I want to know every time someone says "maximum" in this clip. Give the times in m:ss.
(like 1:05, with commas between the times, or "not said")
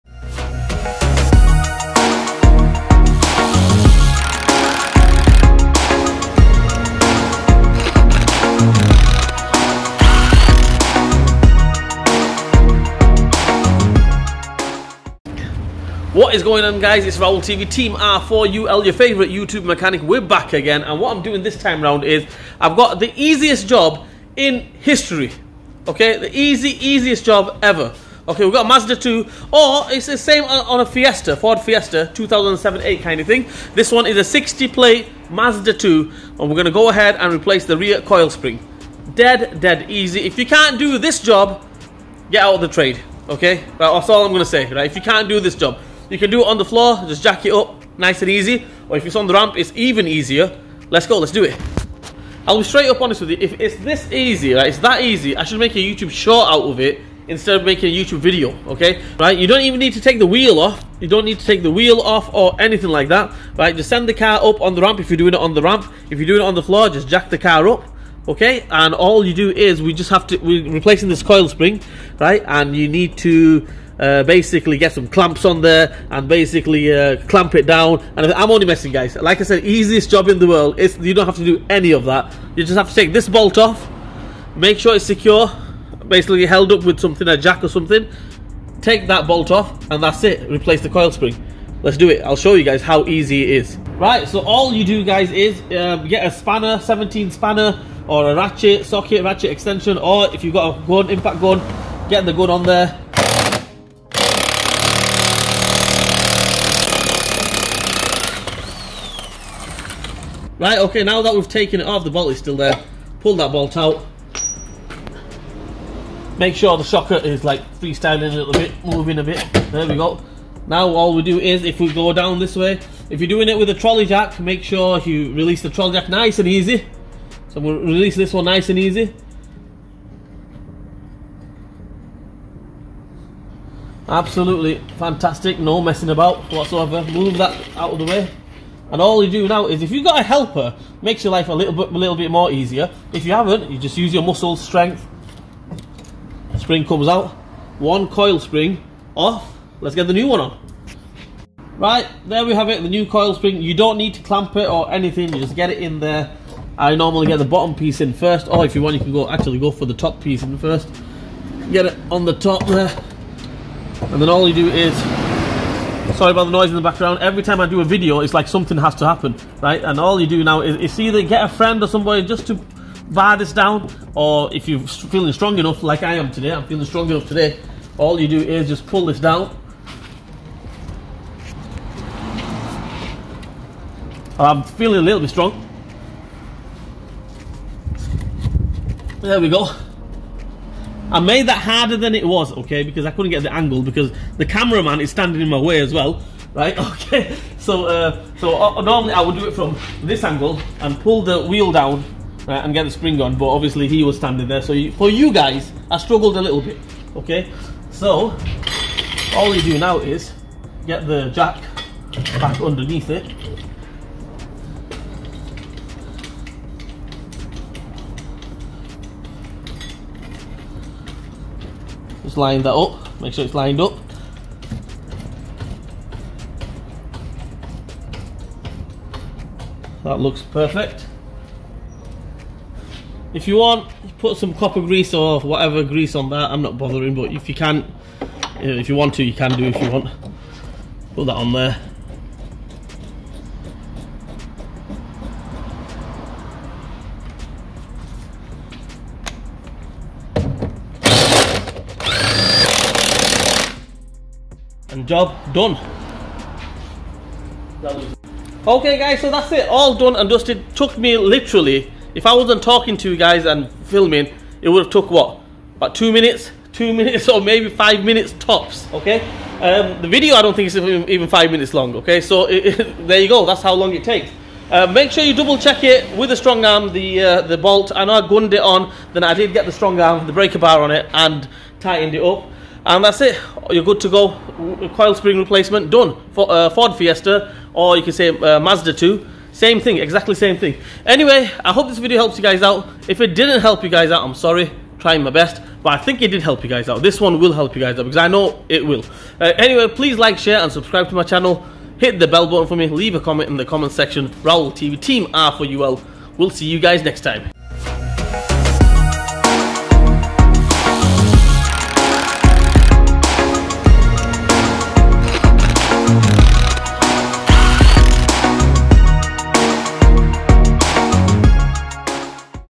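not said.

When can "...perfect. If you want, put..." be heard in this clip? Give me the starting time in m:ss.
3:50.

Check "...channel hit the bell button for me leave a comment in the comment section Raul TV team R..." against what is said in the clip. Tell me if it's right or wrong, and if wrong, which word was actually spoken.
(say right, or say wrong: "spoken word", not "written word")
right.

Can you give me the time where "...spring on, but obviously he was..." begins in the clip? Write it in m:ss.
3:22.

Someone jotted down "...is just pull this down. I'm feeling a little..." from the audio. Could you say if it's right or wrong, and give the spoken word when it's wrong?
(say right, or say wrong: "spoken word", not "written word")
right.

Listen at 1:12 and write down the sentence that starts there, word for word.
And you need to uh, basically get some clamps on there and basically uh, clamp it down.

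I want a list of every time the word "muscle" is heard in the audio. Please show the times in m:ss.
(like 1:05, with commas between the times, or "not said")
2:24.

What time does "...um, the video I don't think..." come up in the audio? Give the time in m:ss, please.
4:29.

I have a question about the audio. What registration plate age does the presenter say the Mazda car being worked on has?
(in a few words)
60 plate.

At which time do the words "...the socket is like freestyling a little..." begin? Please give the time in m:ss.
1:56.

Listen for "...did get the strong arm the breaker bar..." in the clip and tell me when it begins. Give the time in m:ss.
4:39.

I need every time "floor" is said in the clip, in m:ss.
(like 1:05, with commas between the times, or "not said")
0:46, 1:06.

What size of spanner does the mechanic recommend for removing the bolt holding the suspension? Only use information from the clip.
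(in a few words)
17.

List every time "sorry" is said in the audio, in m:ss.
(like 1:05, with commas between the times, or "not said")
2:46, 4:54.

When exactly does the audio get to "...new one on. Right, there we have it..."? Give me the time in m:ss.
2:30.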